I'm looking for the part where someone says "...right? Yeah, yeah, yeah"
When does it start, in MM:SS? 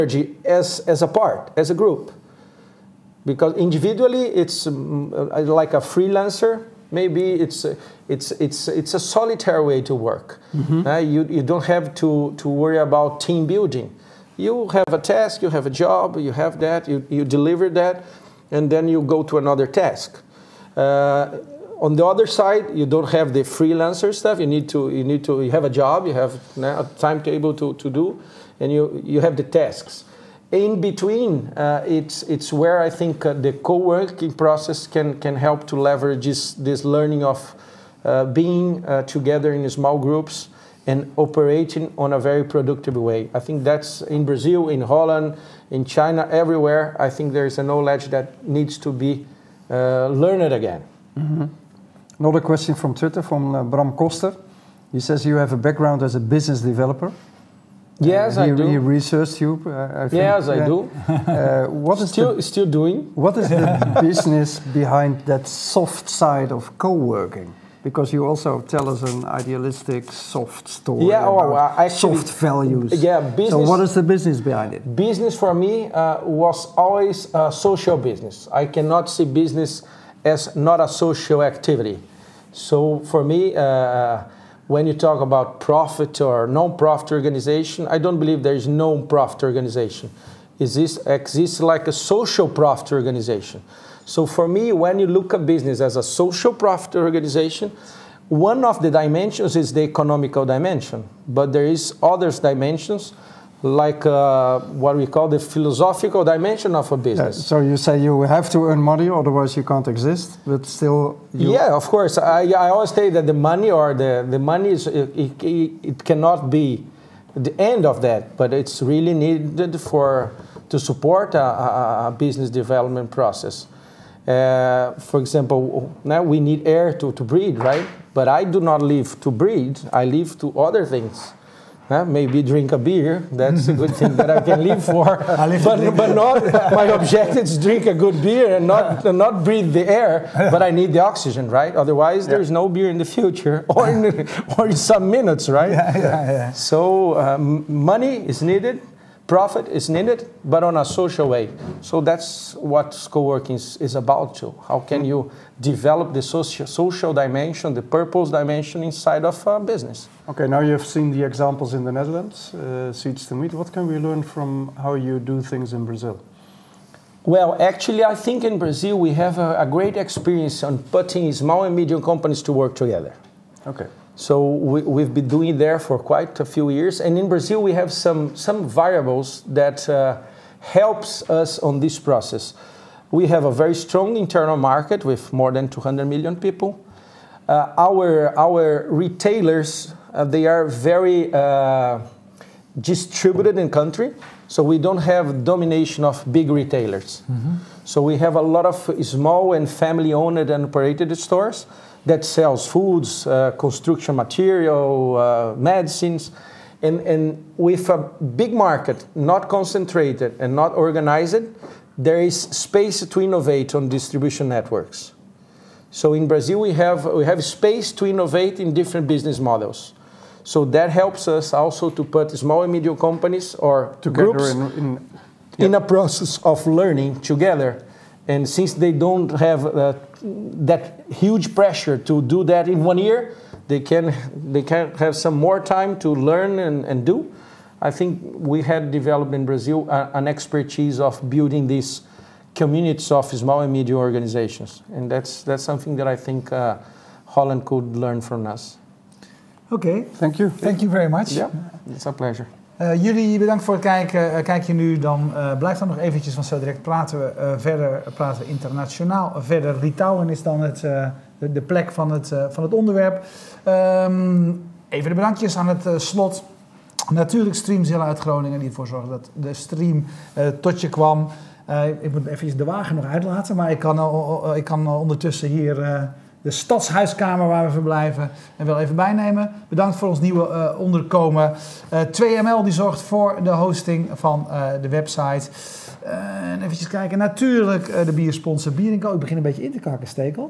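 02:25.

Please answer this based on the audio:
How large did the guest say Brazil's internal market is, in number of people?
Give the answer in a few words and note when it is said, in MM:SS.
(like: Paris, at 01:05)
More than 200 million, at 03:05.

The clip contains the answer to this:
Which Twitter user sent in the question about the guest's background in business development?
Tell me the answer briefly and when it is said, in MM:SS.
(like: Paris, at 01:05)
Bram Koster, at 00:53.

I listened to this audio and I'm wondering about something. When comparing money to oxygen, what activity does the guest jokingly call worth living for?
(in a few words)
Drink a beer.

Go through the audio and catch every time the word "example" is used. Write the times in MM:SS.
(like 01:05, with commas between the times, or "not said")
02:05, 02:41.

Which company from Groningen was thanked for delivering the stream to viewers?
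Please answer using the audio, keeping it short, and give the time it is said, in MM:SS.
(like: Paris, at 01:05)
Streamzilla, at 04:27.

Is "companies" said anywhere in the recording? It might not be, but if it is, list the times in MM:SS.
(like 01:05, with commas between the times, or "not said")
02:52, 03:42.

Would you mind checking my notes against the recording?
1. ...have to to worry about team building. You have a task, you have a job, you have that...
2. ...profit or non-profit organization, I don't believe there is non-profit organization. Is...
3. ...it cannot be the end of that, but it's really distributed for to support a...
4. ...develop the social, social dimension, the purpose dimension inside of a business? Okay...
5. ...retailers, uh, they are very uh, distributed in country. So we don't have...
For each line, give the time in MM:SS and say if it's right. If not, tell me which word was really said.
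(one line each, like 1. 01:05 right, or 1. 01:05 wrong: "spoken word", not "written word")
1. 00:11 right
2. 01:25 right
3. 01:55 wrong: "needed", not "distributed"
4. 02:35 right
5. 03:08 right.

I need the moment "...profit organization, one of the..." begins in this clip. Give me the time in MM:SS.
01:36.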